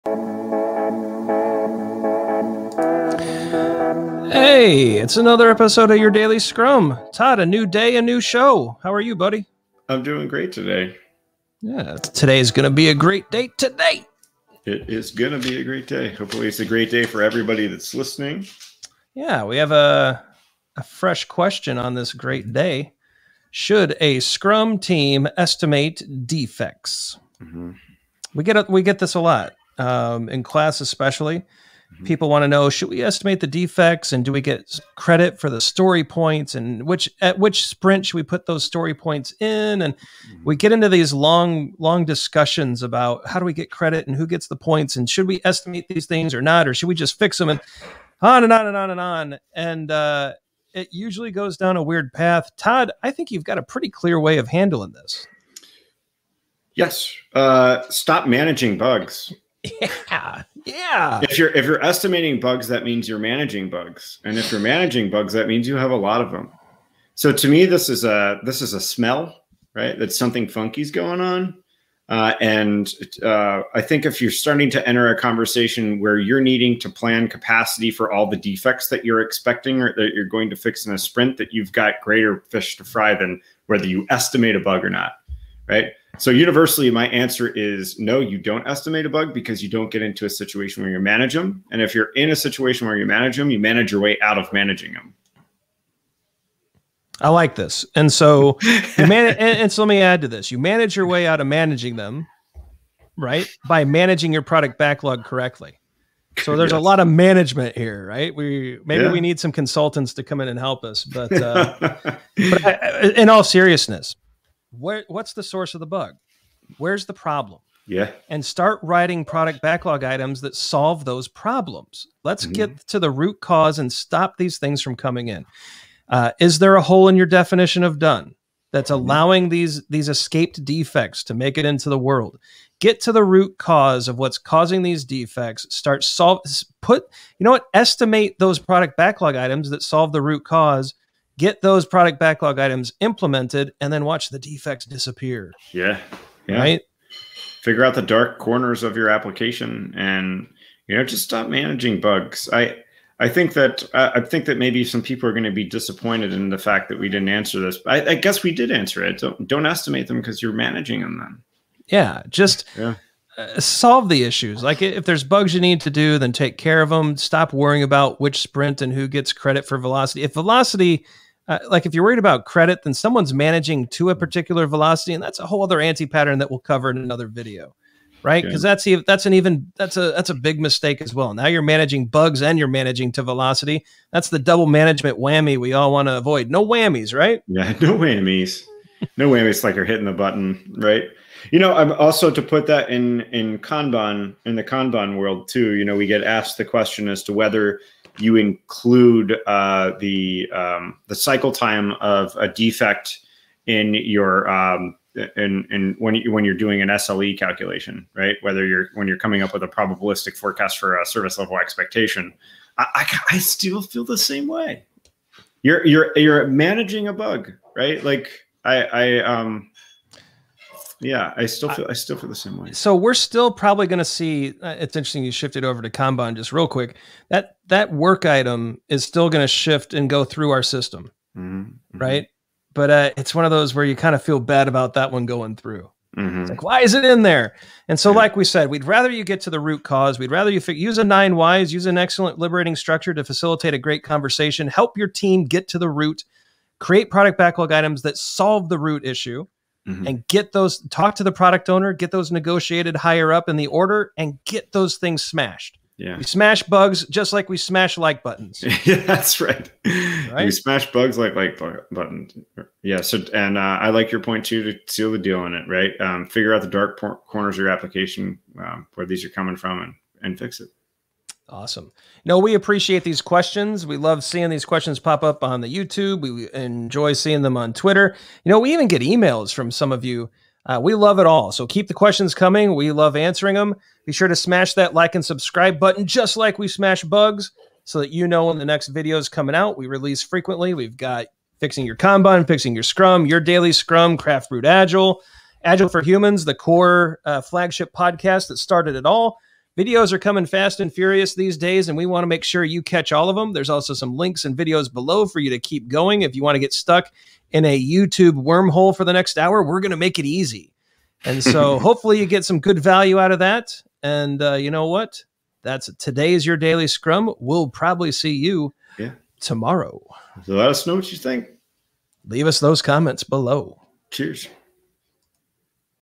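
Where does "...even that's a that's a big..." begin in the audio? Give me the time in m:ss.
2:59.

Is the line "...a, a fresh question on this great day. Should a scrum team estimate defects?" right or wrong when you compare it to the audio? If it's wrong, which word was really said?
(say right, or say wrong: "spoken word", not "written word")
right.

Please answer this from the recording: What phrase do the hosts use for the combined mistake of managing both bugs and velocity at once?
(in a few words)
Double management whammy.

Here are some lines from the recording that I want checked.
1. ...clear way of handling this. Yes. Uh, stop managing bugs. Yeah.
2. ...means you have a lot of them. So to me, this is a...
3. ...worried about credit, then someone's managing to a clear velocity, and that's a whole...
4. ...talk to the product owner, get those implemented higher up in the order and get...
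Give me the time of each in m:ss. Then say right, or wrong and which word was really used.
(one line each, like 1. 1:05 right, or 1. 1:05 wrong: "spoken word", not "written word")
1. 0:53 right
2. 1:05 right
3. 2:52 wrong: "particular", not "clear"
4. 4:10 wrong: "negotiated", not "implemented".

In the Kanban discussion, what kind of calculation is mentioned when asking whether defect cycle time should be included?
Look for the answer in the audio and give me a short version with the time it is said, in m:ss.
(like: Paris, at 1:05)
SLE calculation, at 3:26.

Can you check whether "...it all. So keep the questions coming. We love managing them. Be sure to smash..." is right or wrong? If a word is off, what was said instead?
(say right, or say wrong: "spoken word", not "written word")
wrong: "answering", not "managing".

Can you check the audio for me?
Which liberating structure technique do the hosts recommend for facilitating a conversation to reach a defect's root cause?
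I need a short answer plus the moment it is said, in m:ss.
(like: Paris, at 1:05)
Nine whys, at 4:01.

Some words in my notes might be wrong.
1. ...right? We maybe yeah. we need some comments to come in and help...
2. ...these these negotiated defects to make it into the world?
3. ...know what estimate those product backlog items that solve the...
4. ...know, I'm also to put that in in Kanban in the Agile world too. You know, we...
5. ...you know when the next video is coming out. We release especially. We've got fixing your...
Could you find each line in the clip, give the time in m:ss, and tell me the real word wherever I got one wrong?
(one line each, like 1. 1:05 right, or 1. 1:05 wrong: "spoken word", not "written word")
1. 1:48 wrong: "consultants", not "comments"
2. 2:09 wrong: "escaped", not "negotiated"
3. 2:17 right
4. 3:11 wrong: "Kanban", not "Agile"
5. 4:48 wrong: "frequently", not "especially".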